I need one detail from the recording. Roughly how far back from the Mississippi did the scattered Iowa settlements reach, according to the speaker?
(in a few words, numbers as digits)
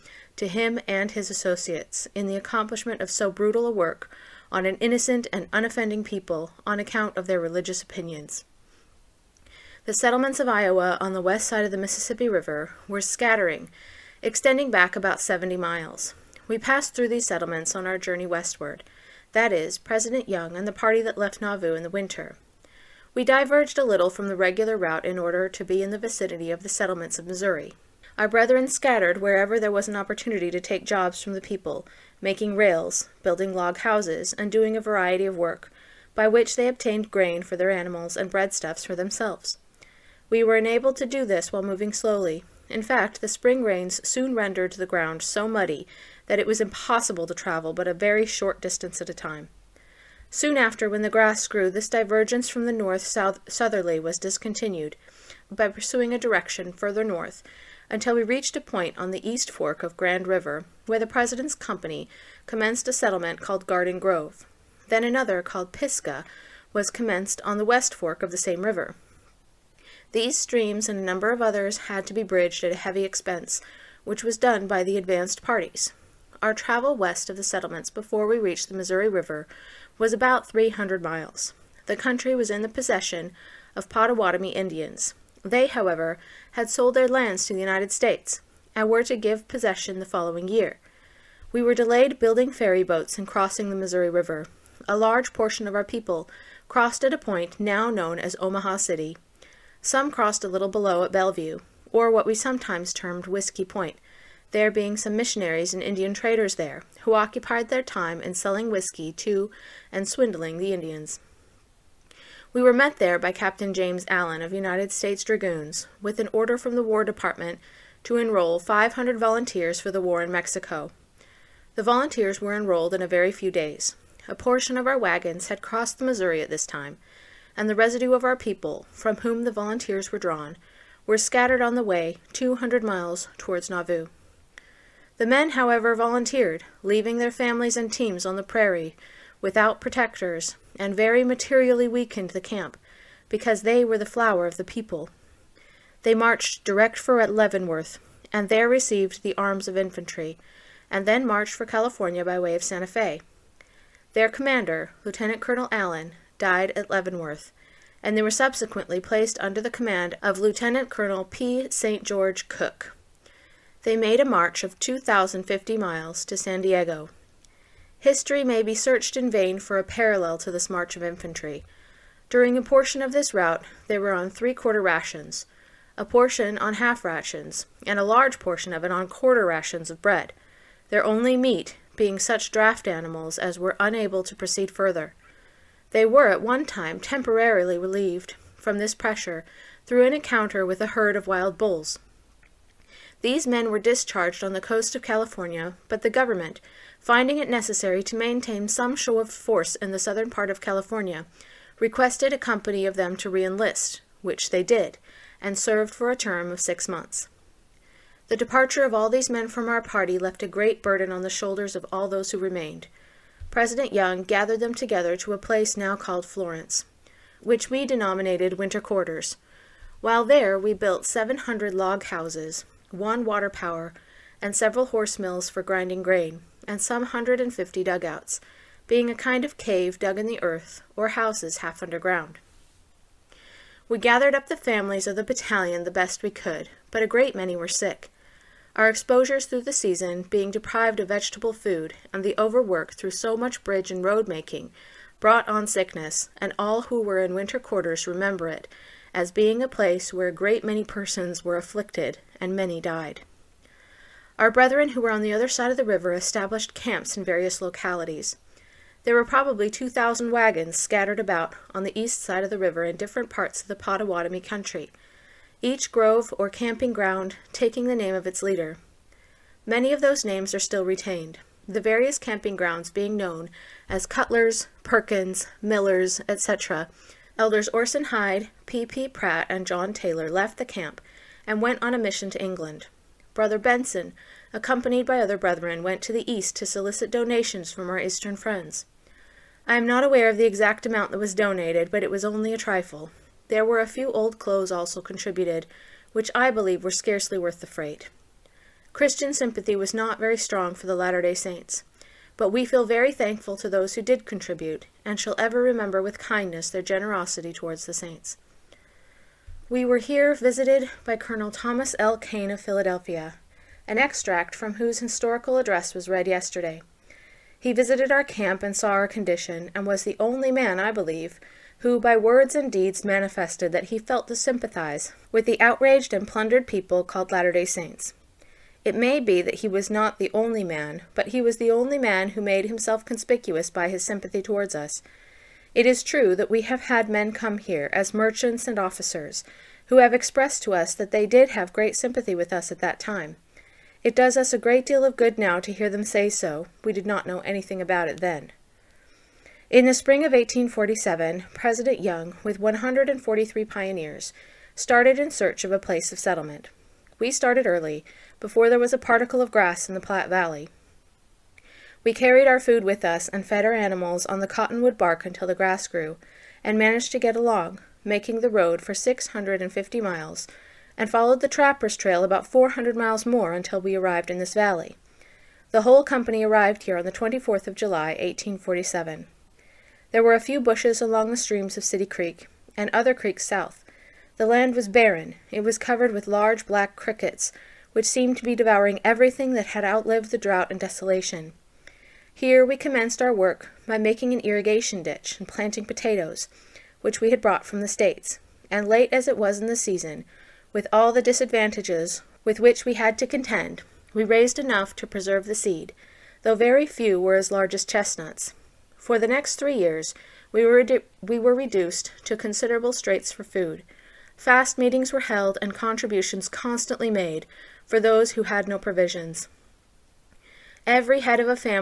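70 miles.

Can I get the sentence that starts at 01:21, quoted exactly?
The country was in the possession of Potawatomi Indians.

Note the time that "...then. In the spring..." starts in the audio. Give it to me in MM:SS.
05:48.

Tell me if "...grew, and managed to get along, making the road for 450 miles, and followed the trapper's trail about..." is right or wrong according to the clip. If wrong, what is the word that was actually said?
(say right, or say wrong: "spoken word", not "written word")
wrong: "650", not "450".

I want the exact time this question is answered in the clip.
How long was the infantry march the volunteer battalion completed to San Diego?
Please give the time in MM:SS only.
02:44.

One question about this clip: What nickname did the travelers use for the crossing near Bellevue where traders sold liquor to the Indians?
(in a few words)
Whiskey Point.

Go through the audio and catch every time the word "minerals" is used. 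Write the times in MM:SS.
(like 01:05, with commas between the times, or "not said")
not said.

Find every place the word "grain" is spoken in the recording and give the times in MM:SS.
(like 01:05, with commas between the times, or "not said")
00:37, 03:46.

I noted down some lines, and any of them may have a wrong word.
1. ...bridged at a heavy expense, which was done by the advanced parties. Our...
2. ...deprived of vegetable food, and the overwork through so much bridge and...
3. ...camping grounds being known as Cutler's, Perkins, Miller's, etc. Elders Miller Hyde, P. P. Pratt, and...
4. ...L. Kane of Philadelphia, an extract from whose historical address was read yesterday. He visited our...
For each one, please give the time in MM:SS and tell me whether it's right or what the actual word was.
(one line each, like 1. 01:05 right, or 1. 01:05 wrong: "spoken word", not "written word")
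1. 01:12 right
2. 04:00 right
3. 04:32 wrong: "Orson", not "Miller"
4. 05:11 right.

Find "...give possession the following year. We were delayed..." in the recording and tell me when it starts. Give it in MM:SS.
01:29.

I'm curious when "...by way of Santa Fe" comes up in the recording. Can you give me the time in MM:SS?
02:32.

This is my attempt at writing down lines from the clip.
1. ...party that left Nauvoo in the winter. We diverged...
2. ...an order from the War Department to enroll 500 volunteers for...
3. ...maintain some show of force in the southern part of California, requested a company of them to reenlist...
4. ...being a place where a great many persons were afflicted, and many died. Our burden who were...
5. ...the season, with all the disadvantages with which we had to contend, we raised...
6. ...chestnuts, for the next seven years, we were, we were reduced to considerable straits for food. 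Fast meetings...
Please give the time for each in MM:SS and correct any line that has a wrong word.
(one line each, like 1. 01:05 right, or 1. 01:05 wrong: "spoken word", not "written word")
1. 00:20 right
2. 01:56 right
3. 03:18 right
4. 04:09 wrong: "brethren", not "burden"
5. 06:39 right
6. 06:47 wrong: "three", not "seven".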